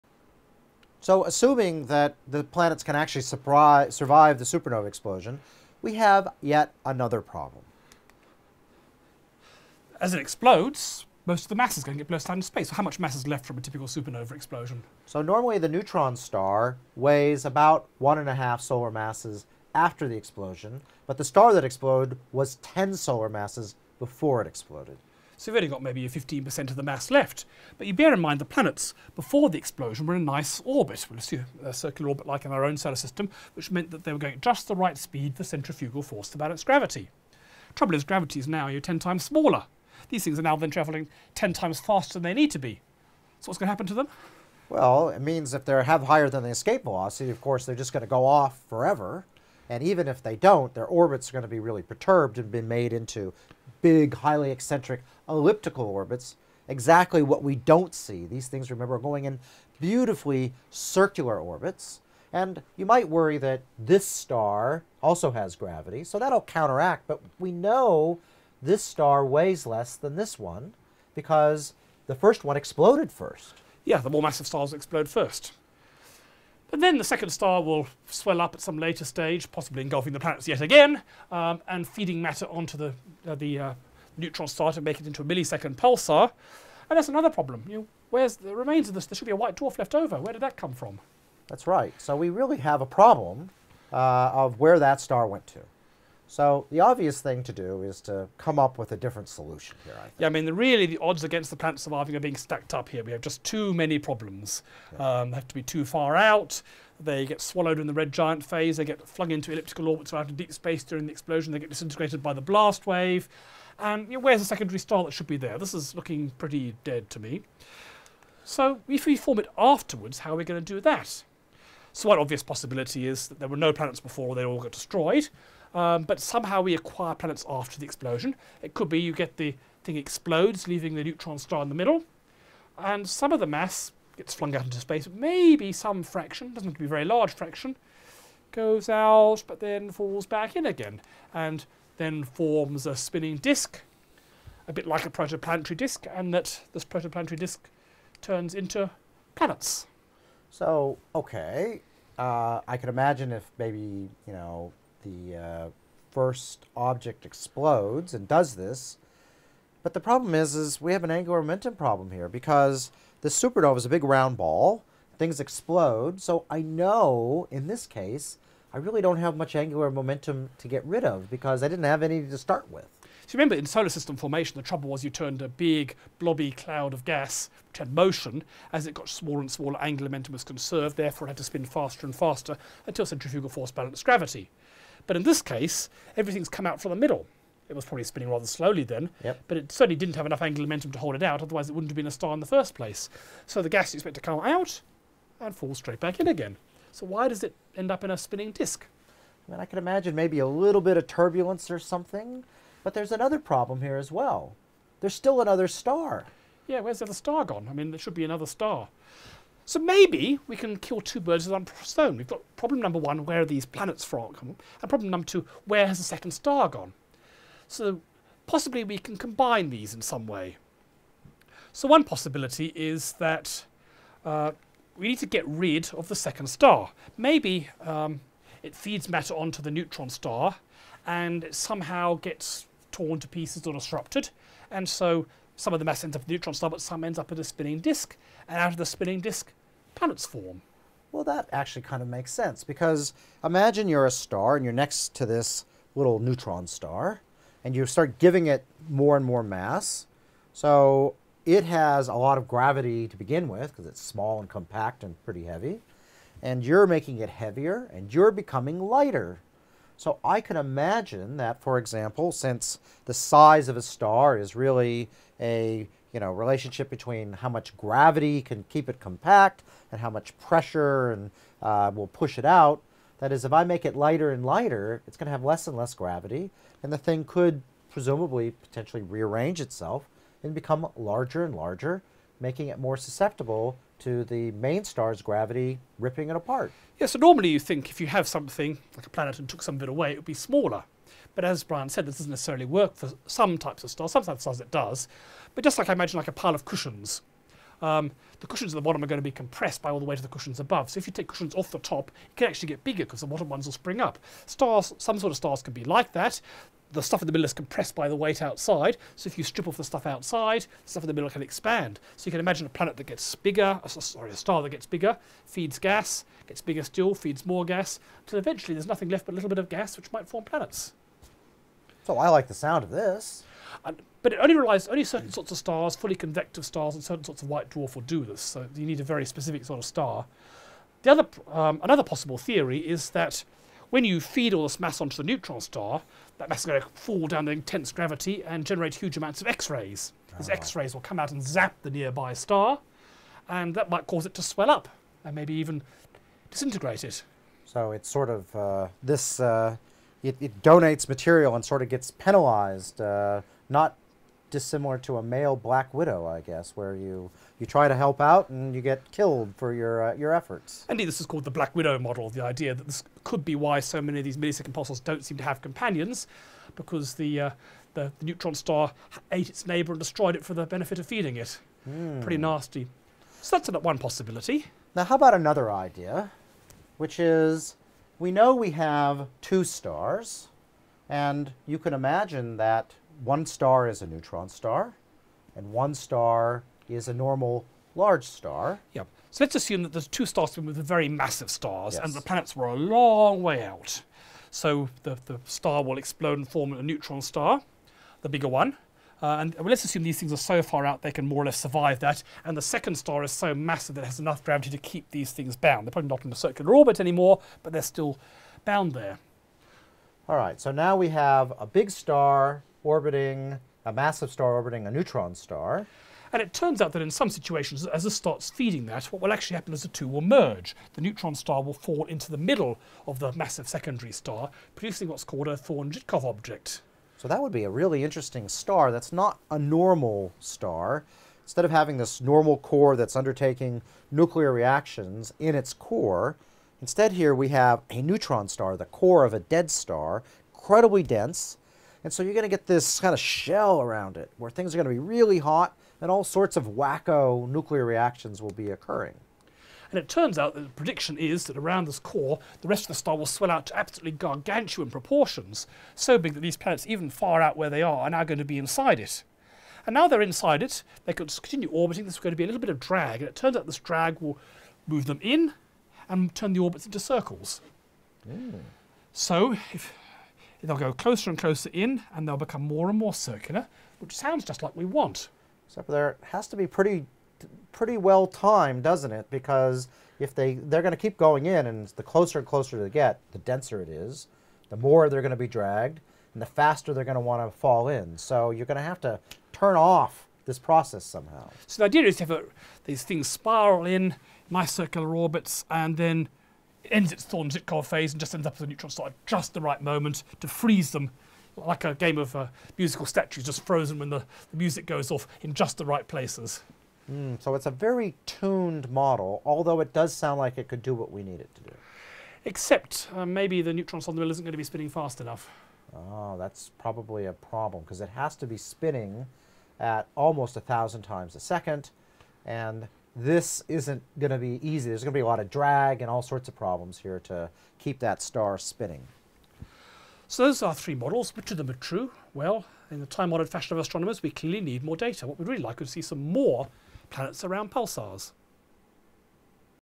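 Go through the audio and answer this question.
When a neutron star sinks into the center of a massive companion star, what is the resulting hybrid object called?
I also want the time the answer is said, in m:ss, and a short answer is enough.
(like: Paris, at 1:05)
Thorne-Zytkow object, at 7:05.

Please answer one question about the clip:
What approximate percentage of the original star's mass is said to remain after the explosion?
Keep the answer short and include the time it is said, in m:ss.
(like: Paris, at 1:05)
15%, at 0:26.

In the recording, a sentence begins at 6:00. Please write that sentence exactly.
Indeed, this is called the Black Widow model.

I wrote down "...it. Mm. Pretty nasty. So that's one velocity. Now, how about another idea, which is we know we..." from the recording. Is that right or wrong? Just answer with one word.
wrong.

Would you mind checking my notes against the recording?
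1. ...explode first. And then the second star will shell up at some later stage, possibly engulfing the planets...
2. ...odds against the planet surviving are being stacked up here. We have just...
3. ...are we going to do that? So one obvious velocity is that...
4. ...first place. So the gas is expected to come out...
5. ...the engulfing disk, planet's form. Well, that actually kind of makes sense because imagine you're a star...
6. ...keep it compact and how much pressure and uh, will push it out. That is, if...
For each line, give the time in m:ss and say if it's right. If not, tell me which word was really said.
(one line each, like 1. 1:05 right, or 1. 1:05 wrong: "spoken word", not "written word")
1. 1:14 wrong: "swell", not "shell"
2. 1:40 right
3. 2:00 wrong: "possibility", not "velocity"
4. 3:12 right
5. 3:58 wrong: "spinning", not "engulfing"
6. 4:28 right.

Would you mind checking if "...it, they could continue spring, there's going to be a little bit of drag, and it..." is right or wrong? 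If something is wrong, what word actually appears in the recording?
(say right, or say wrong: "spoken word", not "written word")
wrong: "orbiting", not "spring".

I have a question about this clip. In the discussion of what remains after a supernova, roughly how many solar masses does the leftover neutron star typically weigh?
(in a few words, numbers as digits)
1.5.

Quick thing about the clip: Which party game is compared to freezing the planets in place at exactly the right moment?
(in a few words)
Musical statues.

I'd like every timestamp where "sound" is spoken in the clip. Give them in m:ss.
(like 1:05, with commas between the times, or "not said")
5:22, 7:54, 8:30.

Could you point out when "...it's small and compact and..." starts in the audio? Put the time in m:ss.
4:13.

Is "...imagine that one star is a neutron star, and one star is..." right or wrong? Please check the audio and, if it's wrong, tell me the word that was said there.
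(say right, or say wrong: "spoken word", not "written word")
right.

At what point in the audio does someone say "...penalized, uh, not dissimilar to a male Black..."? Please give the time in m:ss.
5:52.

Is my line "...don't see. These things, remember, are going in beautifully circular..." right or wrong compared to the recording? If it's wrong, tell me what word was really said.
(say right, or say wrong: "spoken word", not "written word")
right.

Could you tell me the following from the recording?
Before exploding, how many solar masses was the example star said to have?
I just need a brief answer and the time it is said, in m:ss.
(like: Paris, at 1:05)
10, at 0:22.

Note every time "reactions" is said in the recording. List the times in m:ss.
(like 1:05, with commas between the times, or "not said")
7:14, 7:27.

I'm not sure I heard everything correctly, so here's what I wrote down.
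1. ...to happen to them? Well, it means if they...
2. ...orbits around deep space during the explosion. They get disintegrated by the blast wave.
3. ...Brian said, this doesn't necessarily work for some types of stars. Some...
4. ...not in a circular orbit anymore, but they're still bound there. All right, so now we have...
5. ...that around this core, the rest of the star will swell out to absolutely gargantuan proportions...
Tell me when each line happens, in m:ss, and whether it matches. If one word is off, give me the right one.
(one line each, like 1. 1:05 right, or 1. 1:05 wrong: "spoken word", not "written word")
1. 0:43 right
2. 1:49 right
3. 4:51 right
4. 6:46 right
5. 7:31 right.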